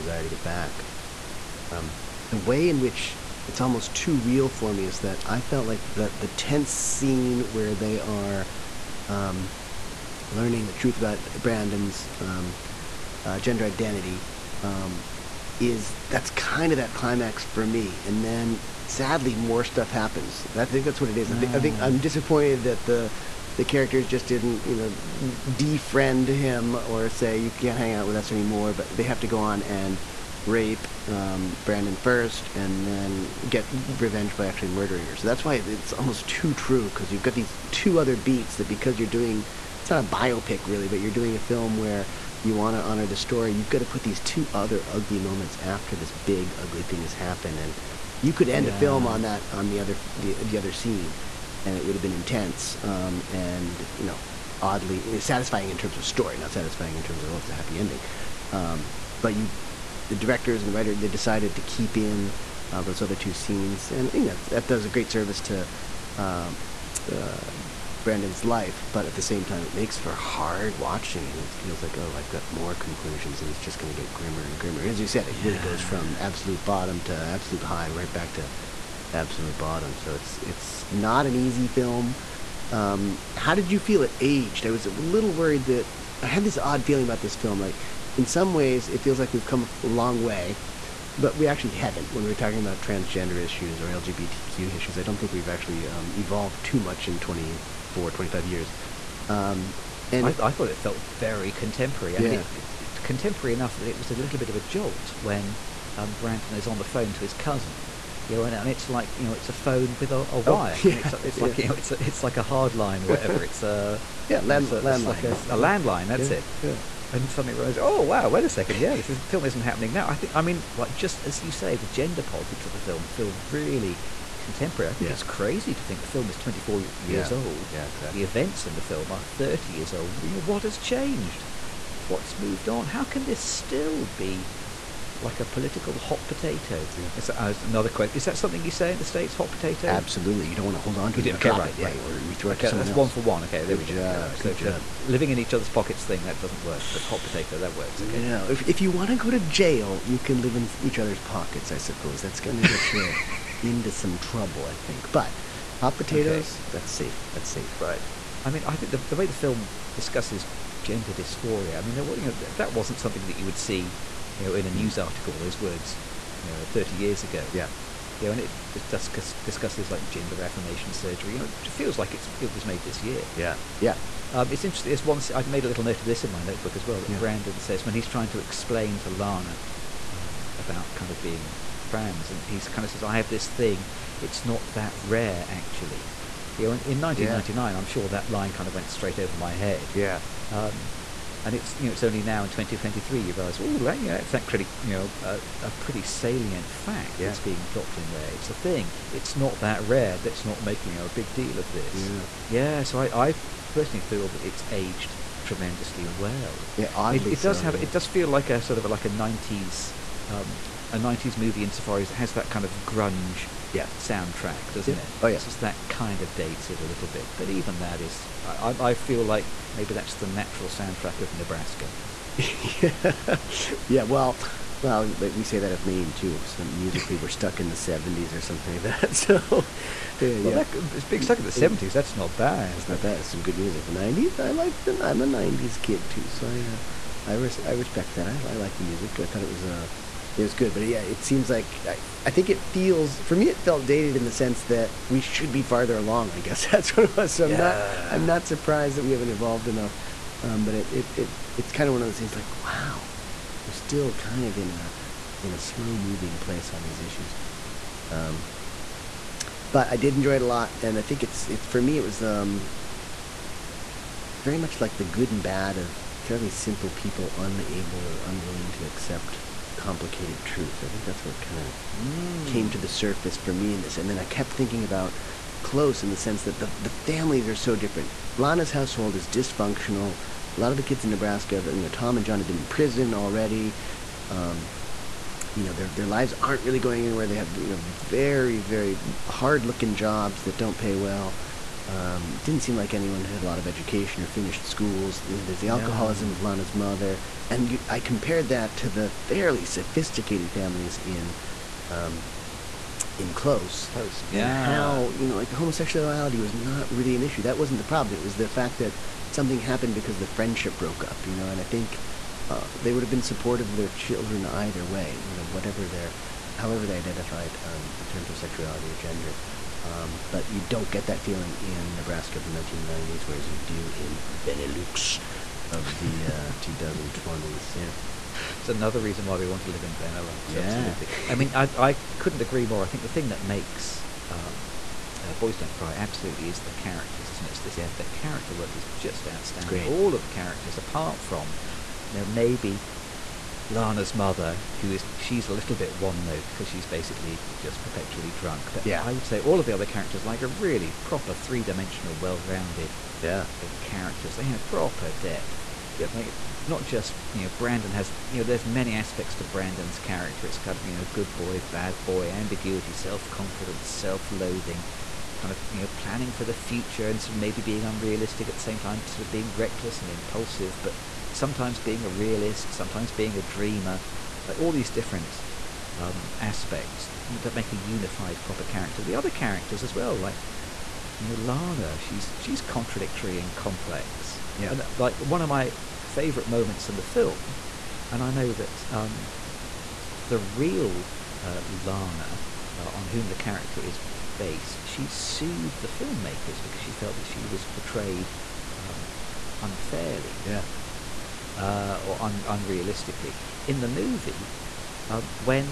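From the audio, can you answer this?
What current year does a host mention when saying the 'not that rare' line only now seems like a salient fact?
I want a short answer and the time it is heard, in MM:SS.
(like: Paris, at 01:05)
2023, at 03:12.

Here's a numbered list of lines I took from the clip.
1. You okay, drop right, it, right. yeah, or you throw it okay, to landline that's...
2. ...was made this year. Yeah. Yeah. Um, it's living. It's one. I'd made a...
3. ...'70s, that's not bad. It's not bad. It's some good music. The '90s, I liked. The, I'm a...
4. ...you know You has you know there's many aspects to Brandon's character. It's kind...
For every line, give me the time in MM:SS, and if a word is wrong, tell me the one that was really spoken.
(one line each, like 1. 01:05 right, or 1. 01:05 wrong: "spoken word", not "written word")
1. 02:21 wrong: "someone", not "landline"
2. 02:52 wrong: "interesting", not "living"
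3. 03:51 right
4. 05:57 wrong: "Brandon", not "You".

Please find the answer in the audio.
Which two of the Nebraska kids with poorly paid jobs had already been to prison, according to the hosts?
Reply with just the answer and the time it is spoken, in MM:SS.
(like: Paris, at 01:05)
Tom and John, at 04:41.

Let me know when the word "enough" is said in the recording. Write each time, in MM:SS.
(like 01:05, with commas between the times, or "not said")
01:43, 04:09.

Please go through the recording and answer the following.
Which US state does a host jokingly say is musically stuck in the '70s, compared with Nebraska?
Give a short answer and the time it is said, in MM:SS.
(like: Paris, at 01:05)
Maine, at 03:45.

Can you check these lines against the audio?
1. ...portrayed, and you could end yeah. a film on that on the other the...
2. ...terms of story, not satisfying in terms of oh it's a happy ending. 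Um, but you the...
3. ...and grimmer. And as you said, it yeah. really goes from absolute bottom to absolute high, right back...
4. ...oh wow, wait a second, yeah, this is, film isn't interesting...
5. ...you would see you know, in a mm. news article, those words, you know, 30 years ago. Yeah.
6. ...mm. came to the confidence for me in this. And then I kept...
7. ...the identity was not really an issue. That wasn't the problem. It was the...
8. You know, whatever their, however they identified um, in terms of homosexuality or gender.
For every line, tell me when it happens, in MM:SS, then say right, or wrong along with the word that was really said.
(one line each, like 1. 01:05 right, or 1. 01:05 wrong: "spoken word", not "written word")
1. 00:47 wrong: "happened", not "portrayed"
2. 00:55 right
3. 01:14 right
4. 01:57 wrong: "happening", not "interesting"
5. 02:43 right
6. 04:31 wrong: "surface", not "confidence"
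7. 05:05 wrong: "homosexuality", not "identity"
8. 05:15 wrong: "sexuality", not "homosexuality".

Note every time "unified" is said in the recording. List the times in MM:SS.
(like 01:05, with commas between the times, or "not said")
06:17.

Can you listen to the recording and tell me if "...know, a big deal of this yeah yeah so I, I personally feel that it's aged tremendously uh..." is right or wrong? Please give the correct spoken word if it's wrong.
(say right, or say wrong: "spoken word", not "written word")
right.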